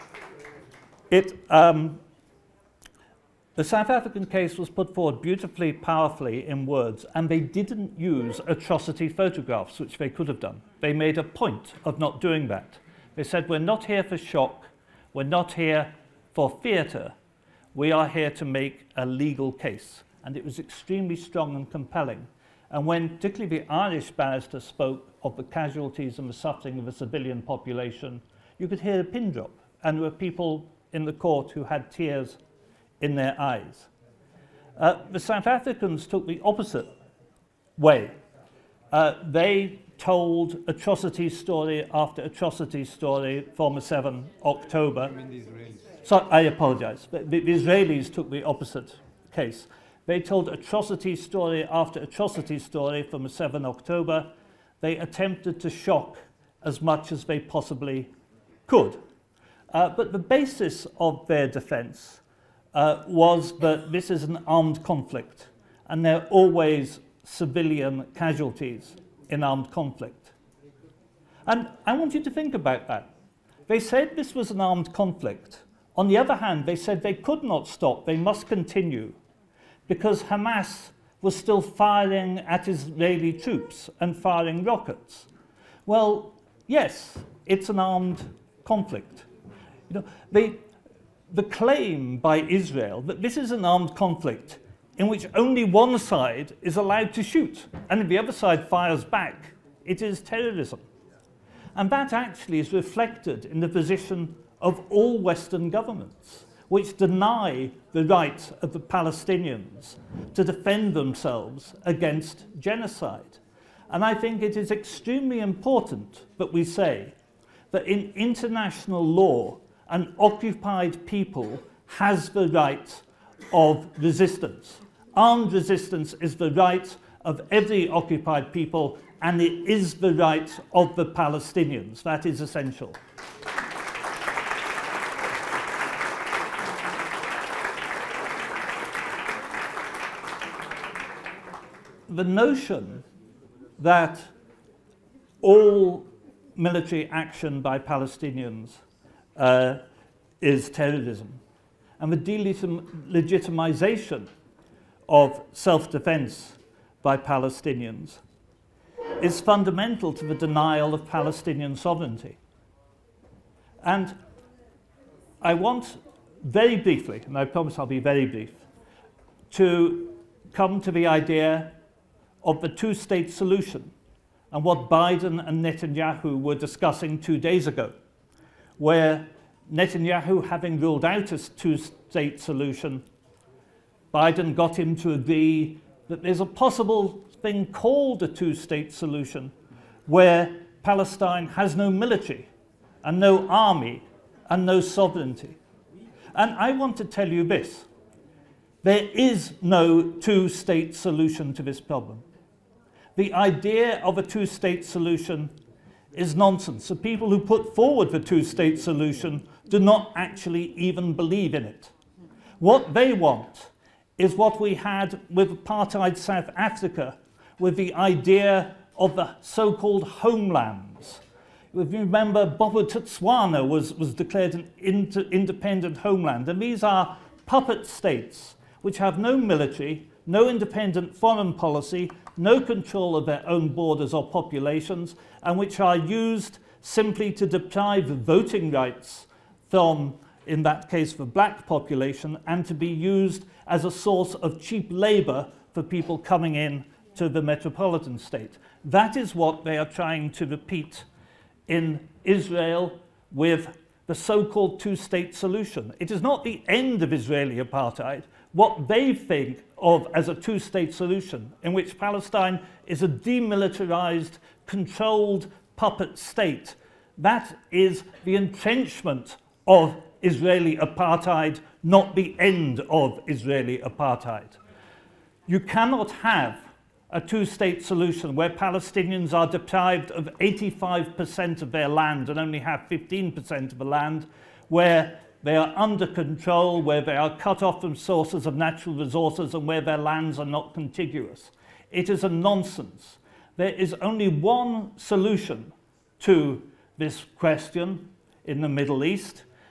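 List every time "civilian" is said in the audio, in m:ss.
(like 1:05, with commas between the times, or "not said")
0:26, 1:07.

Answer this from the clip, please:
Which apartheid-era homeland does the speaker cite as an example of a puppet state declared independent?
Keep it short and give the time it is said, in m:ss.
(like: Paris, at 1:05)
Bobo, at 3:42.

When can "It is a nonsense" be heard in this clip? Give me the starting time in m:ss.
4:51.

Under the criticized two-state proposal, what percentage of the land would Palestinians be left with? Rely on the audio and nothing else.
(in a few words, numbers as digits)
15%.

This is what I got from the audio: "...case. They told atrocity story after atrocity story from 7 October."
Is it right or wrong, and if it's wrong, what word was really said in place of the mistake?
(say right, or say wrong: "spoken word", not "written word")
right.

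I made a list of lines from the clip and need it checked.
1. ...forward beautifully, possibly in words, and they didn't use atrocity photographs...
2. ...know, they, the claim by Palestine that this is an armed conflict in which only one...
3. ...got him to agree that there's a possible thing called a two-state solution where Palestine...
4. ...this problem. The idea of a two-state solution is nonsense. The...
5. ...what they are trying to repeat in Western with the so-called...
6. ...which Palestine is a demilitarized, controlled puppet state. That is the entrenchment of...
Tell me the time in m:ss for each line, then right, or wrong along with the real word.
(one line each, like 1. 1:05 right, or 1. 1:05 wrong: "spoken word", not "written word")
1. 0:04 wrong: "powerfully", not "possibly"
2. 1:30 wrong: "Israel", not "Palestine"
3. 3:04 right
4. 3:21 right
5. 4:09 wrong: "Israel", not "Western"
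6. 4:21 right.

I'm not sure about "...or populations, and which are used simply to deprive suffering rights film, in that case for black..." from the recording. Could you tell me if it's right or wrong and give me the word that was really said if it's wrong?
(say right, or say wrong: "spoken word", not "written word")
wrong: "voting", not "suffering".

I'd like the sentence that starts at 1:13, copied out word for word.
They said this was an armed conflict.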